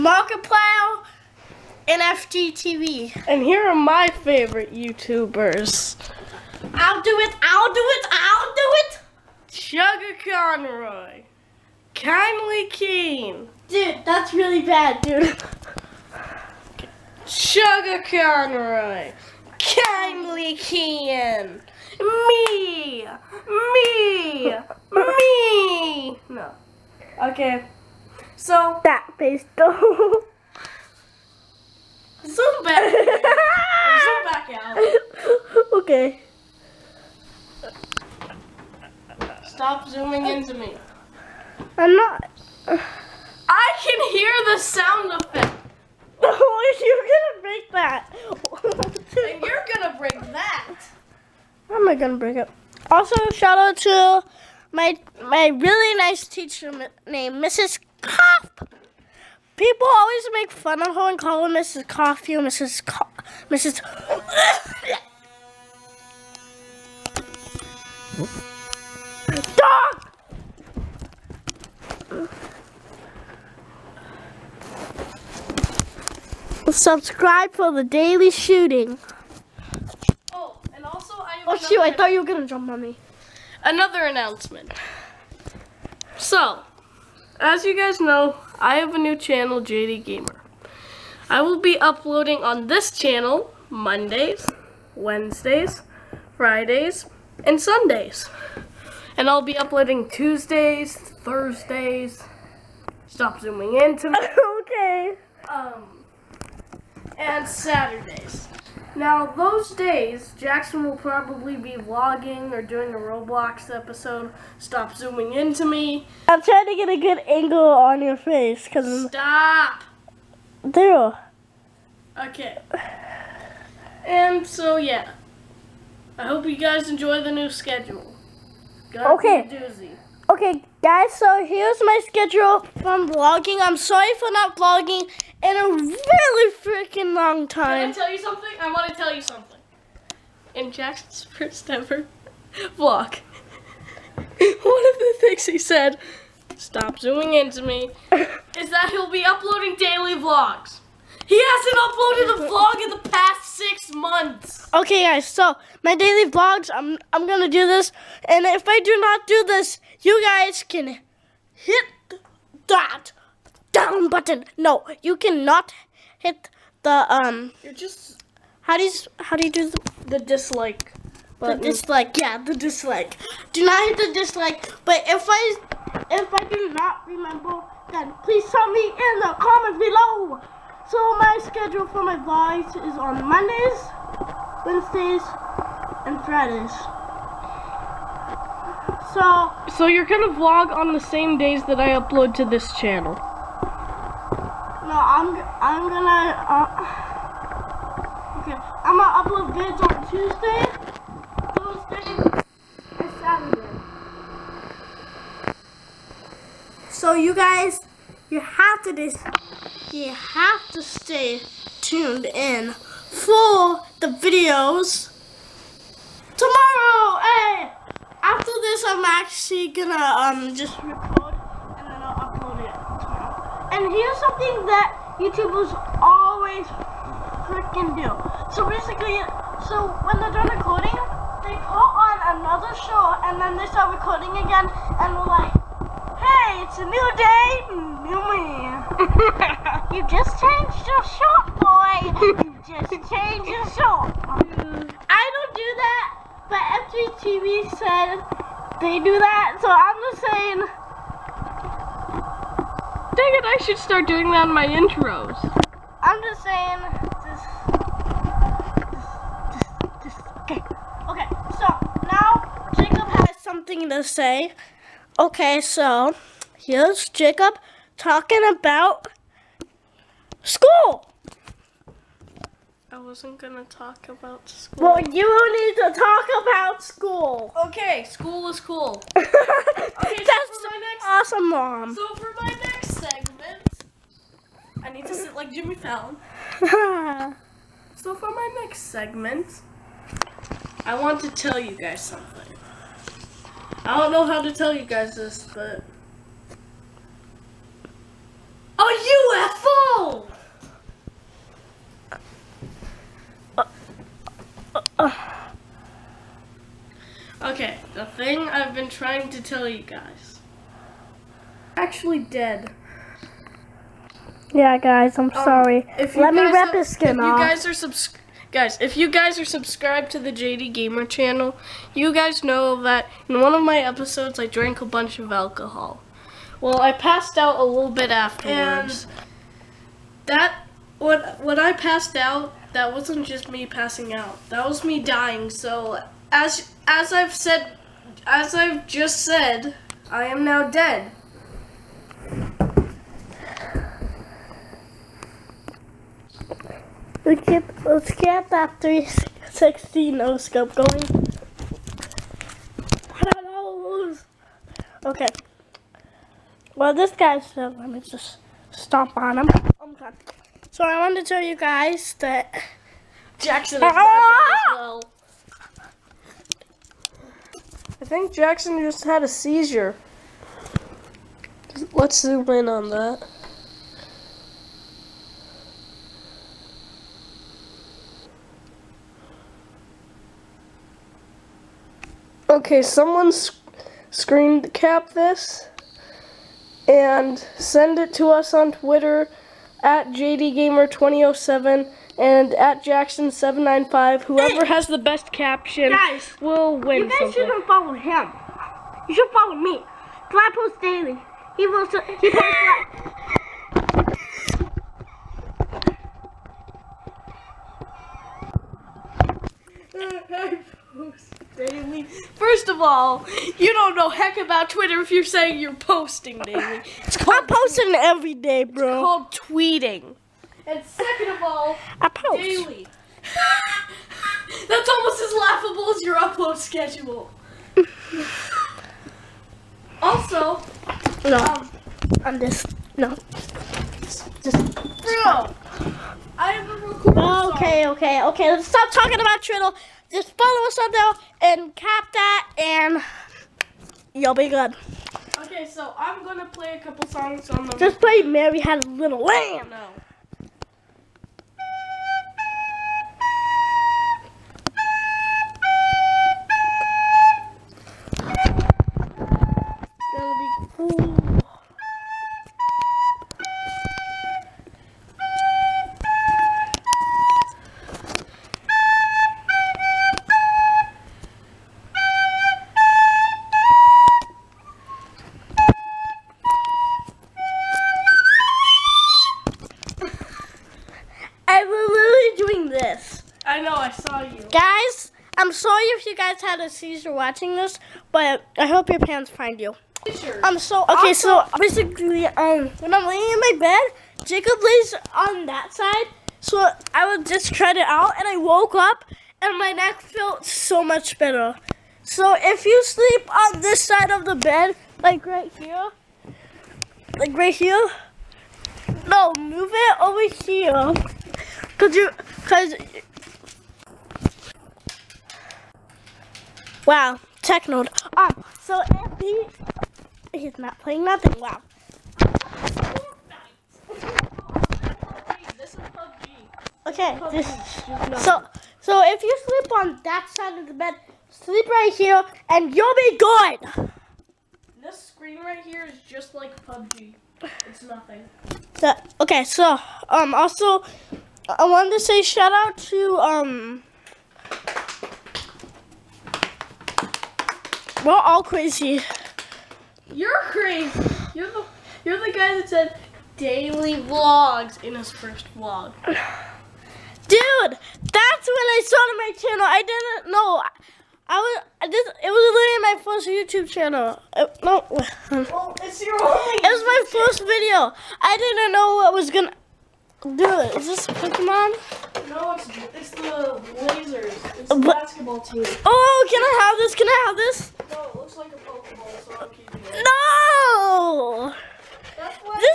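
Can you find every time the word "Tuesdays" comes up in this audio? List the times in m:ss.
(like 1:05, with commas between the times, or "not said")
1:40, 3:20.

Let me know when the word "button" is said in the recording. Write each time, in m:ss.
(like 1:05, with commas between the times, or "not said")
2:44, 2:51.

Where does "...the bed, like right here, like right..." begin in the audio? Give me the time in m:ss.
8:24.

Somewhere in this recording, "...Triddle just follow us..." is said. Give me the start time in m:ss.
7:19.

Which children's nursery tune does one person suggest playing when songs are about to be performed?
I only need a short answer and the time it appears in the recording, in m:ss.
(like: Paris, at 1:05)
Mary Had a Little Lamb, at 7:28.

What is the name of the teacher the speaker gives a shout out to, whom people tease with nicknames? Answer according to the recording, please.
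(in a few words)
Mrs. Kopp.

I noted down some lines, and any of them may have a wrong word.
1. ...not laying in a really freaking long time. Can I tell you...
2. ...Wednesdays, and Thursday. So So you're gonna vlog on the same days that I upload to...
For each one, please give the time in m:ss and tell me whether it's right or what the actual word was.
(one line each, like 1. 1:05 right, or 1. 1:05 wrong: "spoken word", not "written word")
1. 2:14 wrong: "vlogging", not "laying"
2. 3:04 wrong: "Fridays", not "Thursday".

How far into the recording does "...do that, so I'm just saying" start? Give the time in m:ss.
4:08.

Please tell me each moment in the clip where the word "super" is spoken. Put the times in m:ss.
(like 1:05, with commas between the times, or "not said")
not said.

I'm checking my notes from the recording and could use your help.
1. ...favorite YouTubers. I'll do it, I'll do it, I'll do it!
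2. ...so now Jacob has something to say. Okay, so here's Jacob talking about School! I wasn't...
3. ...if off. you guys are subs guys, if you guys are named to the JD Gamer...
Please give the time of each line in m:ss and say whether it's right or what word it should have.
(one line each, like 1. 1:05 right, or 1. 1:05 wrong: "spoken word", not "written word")
1. 0:04 right
2. 4:21 right
3. 5:17 wrong: "subscribed", not "named".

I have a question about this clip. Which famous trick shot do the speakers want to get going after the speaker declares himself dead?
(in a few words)
360 no scope.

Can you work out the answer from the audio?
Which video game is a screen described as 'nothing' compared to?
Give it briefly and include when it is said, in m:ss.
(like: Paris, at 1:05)
PUBG, at 8:56.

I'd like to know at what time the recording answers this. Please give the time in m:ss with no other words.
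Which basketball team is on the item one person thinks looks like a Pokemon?
9:33.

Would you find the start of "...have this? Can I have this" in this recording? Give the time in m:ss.
9:36.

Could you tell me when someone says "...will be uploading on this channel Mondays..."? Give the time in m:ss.
1:31.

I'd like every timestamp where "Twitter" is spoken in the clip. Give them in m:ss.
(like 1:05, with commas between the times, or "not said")
6:28, 6:54.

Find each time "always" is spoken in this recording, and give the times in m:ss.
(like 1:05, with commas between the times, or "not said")
0:59, 3:46.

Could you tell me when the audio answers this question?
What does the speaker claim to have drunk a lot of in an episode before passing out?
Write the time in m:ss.
5:25.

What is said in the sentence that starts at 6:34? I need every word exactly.
Whoever has the best caption guys, will win You guys something.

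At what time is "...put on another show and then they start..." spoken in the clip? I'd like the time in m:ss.
3:51.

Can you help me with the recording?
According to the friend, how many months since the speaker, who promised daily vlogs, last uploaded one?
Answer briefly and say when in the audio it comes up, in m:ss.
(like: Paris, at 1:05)
6, at 2:33.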